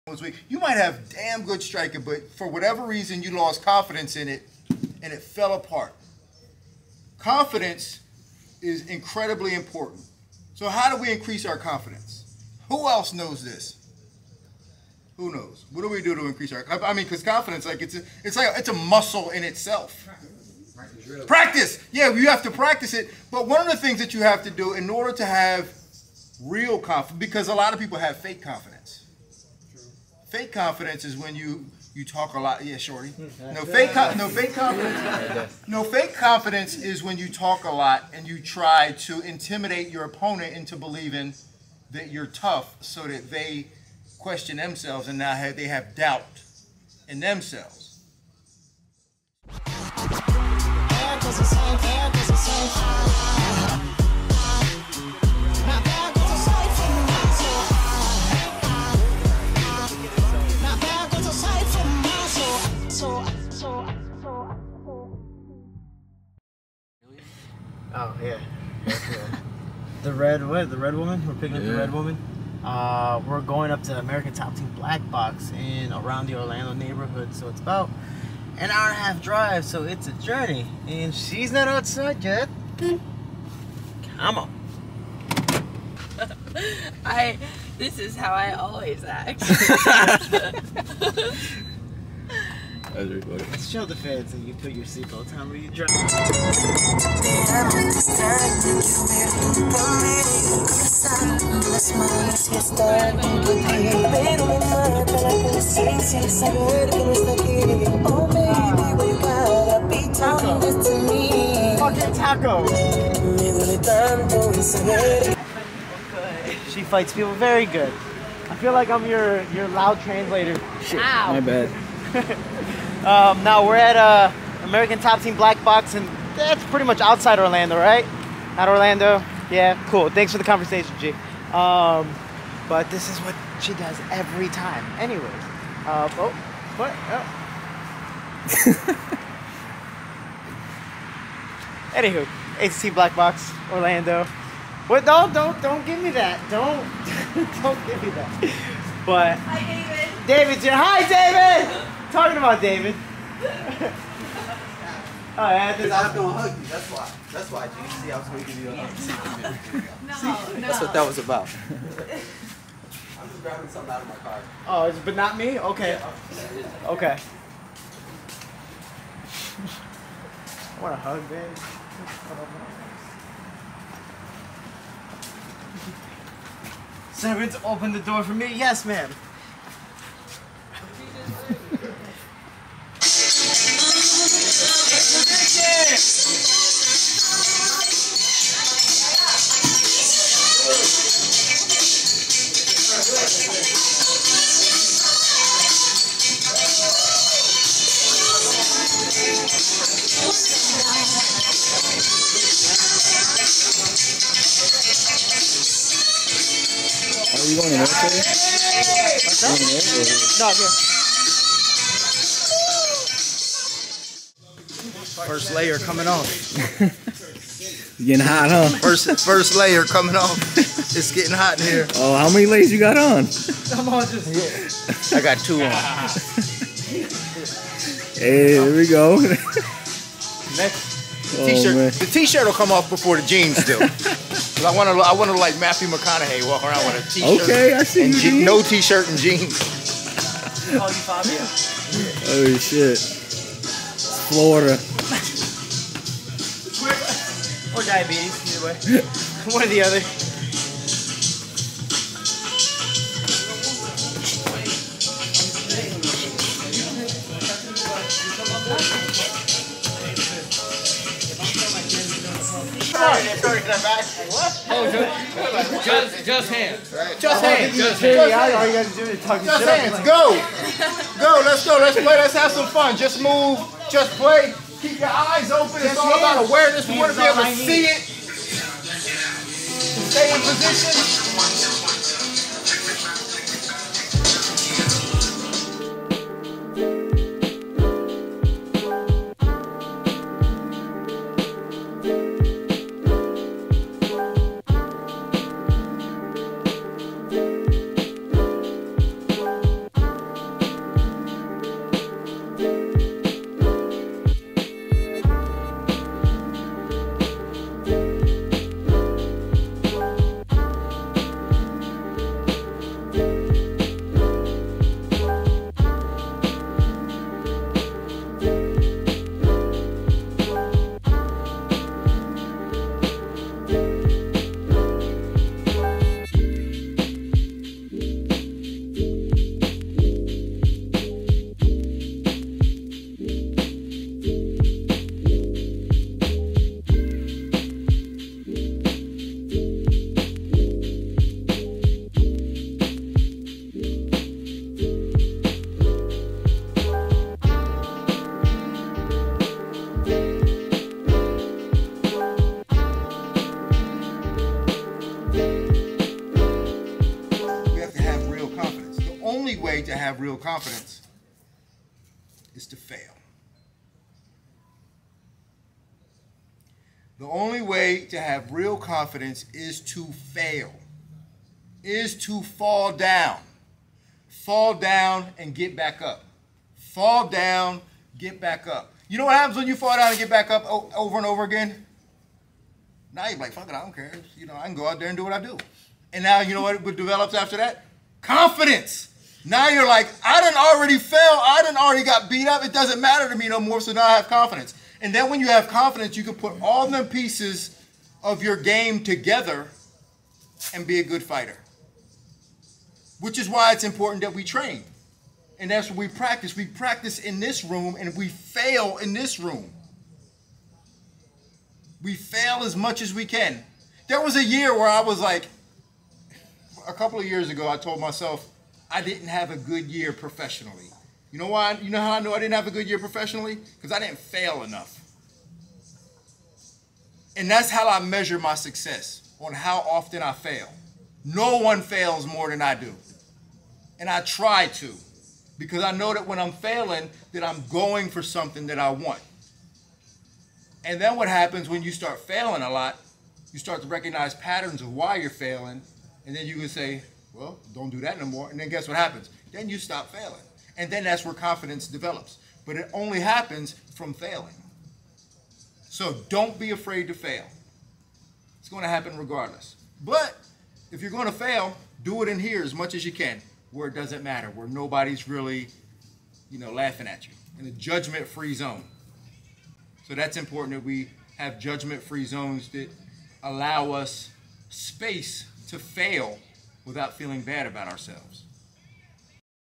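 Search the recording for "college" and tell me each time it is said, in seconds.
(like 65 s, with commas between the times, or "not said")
not said.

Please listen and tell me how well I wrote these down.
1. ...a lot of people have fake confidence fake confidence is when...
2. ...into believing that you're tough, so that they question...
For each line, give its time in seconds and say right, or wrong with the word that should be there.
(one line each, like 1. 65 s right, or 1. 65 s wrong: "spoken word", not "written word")
1. 27 s right
2. 40 s right.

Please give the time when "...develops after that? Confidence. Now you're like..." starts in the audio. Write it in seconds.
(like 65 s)
386 s.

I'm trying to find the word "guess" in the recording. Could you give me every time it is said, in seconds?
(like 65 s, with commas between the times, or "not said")
448 s.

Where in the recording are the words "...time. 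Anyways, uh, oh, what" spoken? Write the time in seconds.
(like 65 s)
134 s.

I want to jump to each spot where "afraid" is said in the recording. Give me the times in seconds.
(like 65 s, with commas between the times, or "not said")
456 s.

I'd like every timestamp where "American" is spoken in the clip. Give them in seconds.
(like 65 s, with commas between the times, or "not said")
73 s, 124 s.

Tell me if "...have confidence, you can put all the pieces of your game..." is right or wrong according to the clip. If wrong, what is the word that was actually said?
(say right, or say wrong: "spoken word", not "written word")
right.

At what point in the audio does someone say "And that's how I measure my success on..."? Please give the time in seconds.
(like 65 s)
427 s.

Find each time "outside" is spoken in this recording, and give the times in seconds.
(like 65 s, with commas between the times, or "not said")
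81 s, 127 s.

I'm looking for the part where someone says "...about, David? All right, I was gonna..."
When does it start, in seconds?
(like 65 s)
152 s.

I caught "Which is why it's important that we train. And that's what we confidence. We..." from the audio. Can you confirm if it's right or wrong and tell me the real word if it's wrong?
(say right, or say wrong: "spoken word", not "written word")
wrong: "practice", not "confidence".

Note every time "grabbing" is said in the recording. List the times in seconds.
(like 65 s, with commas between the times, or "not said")
163 s.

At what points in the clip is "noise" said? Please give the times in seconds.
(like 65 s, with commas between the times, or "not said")
not said.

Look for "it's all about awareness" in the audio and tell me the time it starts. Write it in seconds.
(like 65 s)
275 s.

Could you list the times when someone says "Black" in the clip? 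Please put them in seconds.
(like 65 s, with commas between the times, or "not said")
74 s, 125 s, 142 s.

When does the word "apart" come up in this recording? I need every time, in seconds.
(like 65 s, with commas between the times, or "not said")
5 s.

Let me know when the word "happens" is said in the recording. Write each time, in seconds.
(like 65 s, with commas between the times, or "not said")
379 s, 441 s, 448 s, 453 s, 458 s.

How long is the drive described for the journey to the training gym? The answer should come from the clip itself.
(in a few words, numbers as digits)
An hour and a half.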